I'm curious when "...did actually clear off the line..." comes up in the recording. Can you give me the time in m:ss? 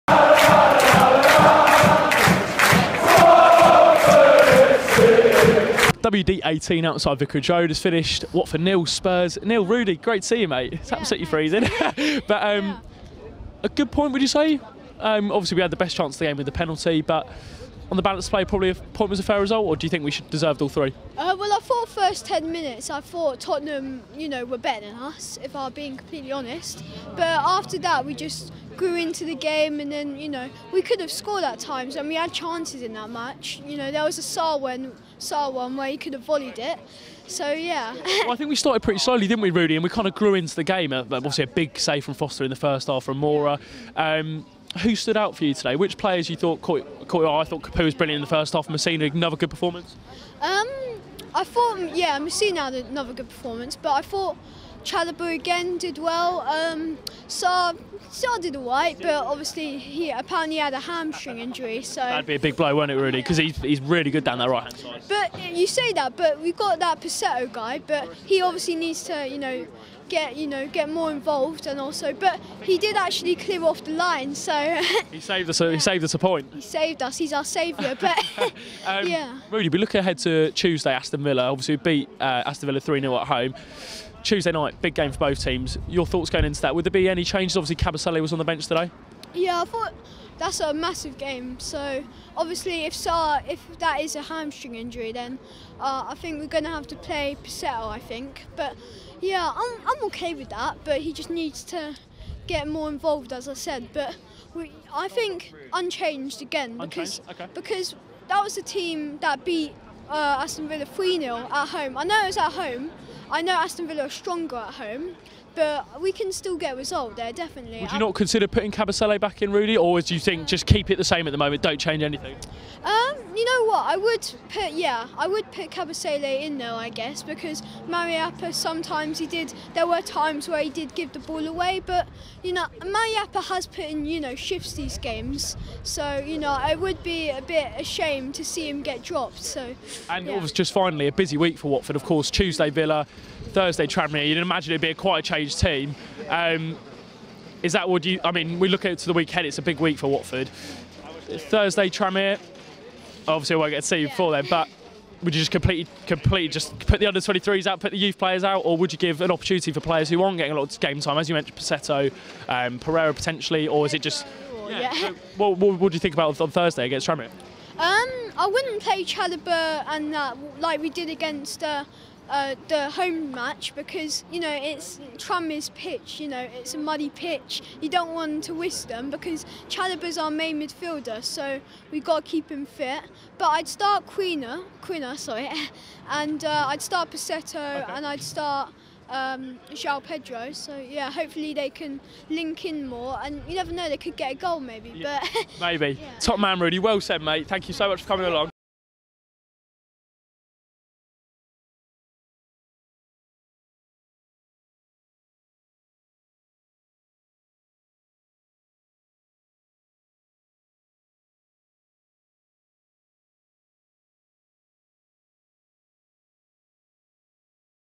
1:12.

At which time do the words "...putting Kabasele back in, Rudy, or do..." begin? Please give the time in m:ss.
1:58.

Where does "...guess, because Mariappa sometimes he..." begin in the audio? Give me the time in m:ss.
2:06.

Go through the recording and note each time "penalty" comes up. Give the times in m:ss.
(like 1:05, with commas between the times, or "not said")
0:16.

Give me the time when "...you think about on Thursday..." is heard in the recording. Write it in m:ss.
2:45.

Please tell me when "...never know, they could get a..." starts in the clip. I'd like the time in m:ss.
3:13.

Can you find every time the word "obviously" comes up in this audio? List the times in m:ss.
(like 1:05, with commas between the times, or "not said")
0:15, 0:41, 0:59, 1:08, 1:21, 1:27, 1:32, 2:33.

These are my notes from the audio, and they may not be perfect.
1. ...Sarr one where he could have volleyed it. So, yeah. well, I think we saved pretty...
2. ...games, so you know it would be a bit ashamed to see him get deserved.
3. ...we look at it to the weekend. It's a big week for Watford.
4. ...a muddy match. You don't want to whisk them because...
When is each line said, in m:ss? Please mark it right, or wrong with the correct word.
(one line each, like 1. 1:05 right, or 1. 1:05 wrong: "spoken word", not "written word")
1. 0:35 wrong: "started", not "saved"
2. 2:14 wrong: "dropped", not "deserved"
3. 2:28 right
4. 2:56 wrong: "pitch", not "match".